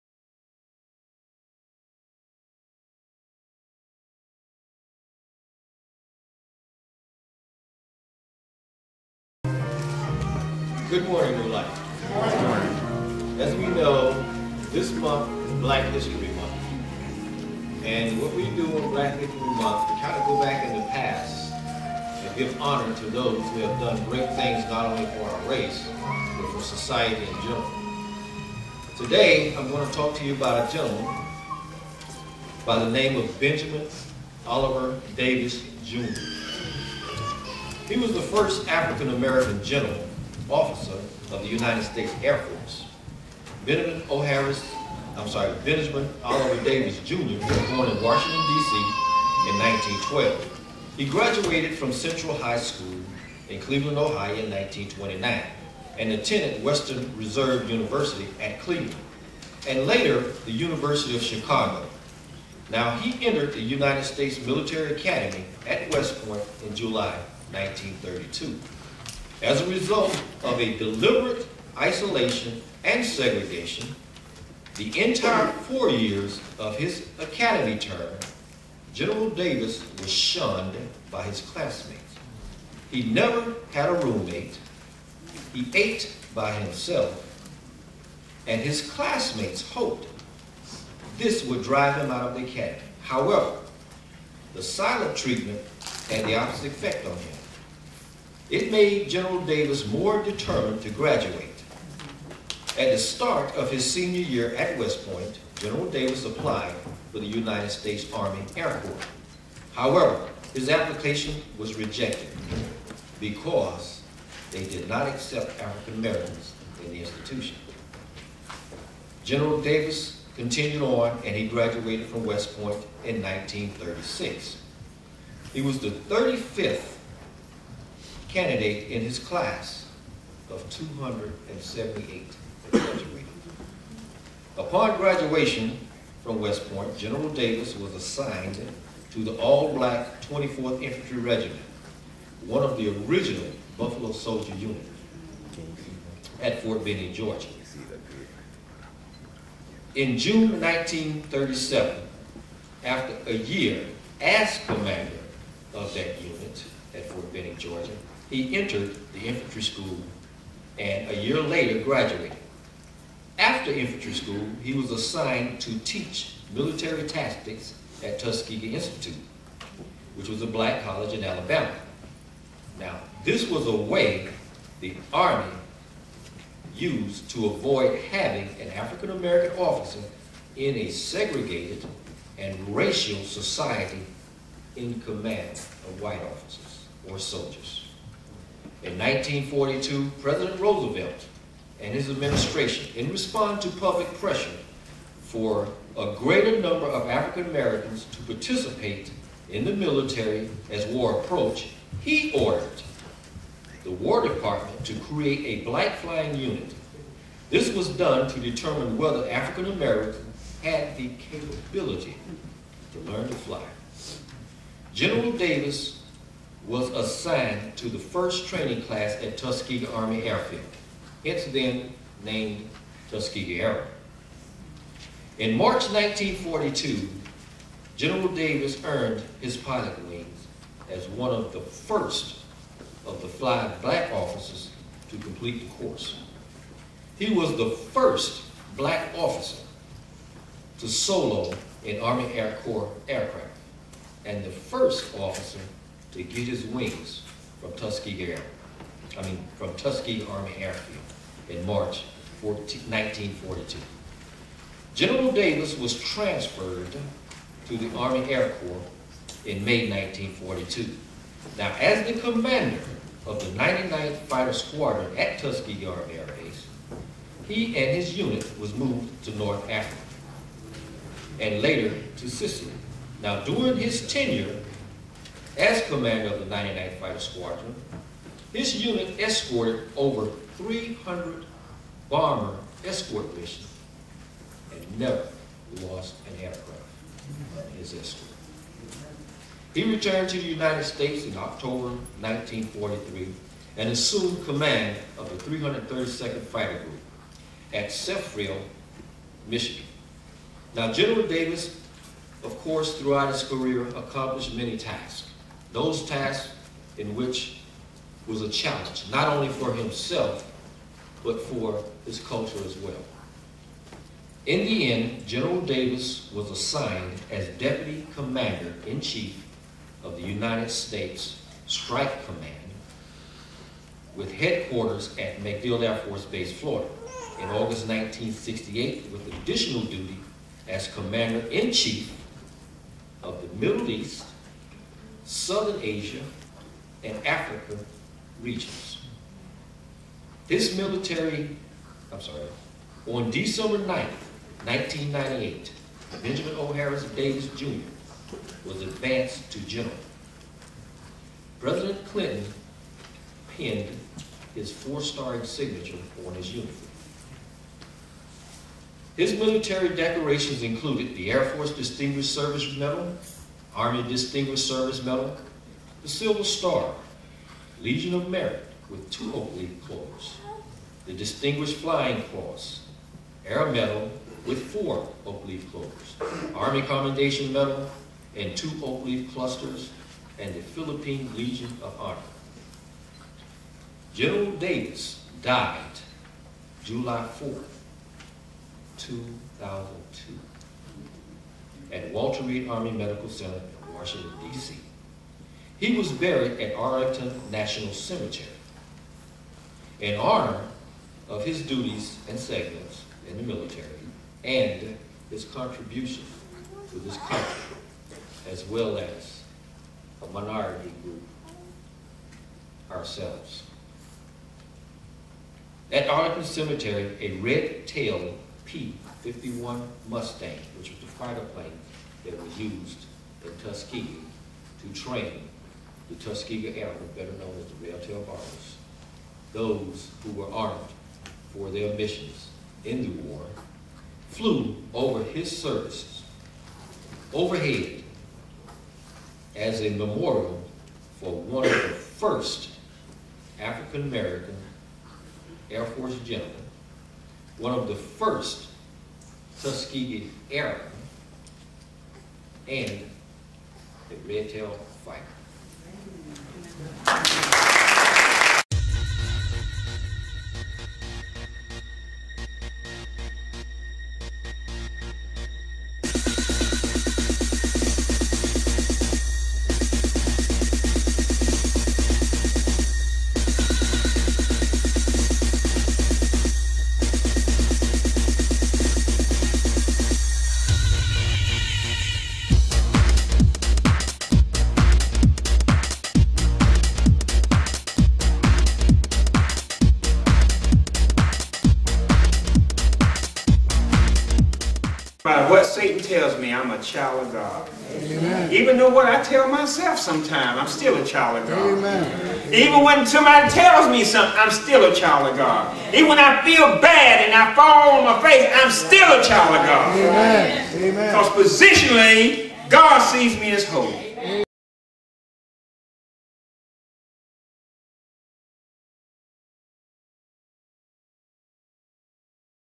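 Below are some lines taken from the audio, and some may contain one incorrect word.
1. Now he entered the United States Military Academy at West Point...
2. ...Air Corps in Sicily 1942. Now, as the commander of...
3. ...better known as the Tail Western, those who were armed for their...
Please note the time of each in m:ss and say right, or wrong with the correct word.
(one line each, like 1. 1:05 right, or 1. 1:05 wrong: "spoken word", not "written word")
1. 1:02 right
2. 4:18 wrong: "May", not "Sicily"
3. 7:07 wrong: "Barbers", not "Western".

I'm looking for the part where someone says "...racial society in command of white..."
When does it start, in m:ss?
3:02.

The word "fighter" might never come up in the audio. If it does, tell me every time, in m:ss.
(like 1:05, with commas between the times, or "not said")
4:24, 4:36, 4:56, 7:01, 7:35.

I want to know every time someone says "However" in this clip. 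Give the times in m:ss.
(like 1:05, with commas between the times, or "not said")
1:33, 1:49.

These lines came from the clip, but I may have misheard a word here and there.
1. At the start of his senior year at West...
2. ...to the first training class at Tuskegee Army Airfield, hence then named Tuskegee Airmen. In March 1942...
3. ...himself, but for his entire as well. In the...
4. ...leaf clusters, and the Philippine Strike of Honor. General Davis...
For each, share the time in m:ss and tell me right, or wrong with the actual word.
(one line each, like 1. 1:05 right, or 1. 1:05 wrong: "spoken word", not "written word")
1. 1:42 right
2. 3:37 right
3. 5:09 wrong: "culture", not "entire"
4. 6:19 wrong: "Legion", not "Strike".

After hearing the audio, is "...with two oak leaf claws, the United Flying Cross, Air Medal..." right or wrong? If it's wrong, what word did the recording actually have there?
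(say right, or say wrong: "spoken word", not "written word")
wrong: "Distinguished", not "United".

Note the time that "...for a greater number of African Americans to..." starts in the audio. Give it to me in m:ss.
3:15.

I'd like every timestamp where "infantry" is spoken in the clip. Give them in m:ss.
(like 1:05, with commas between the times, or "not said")
2:20, 2:39, 2:43.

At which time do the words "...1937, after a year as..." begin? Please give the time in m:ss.
2:30.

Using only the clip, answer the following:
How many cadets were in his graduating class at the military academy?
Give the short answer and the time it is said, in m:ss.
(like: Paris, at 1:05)
278, at 2:10.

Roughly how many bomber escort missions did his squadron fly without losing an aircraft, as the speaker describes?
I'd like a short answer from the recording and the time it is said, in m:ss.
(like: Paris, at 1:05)
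over 300, at 4:39.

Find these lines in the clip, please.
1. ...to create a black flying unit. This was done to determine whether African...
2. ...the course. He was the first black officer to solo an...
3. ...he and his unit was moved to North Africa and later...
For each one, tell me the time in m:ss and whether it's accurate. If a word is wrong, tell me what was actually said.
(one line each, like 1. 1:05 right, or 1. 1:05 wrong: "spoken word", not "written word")
1. 3:24 right
2. 3:55 right
3. 4:27 right.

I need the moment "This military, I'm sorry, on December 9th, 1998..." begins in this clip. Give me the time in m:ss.
5:40.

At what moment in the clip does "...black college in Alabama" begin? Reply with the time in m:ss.
2:50.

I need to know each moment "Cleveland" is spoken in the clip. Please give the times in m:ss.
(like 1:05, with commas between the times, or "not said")
0:53, 0:58.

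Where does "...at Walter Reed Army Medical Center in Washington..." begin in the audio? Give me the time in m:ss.
6:31.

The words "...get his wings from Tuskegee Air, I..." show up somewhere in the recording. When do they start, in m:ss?
4:06.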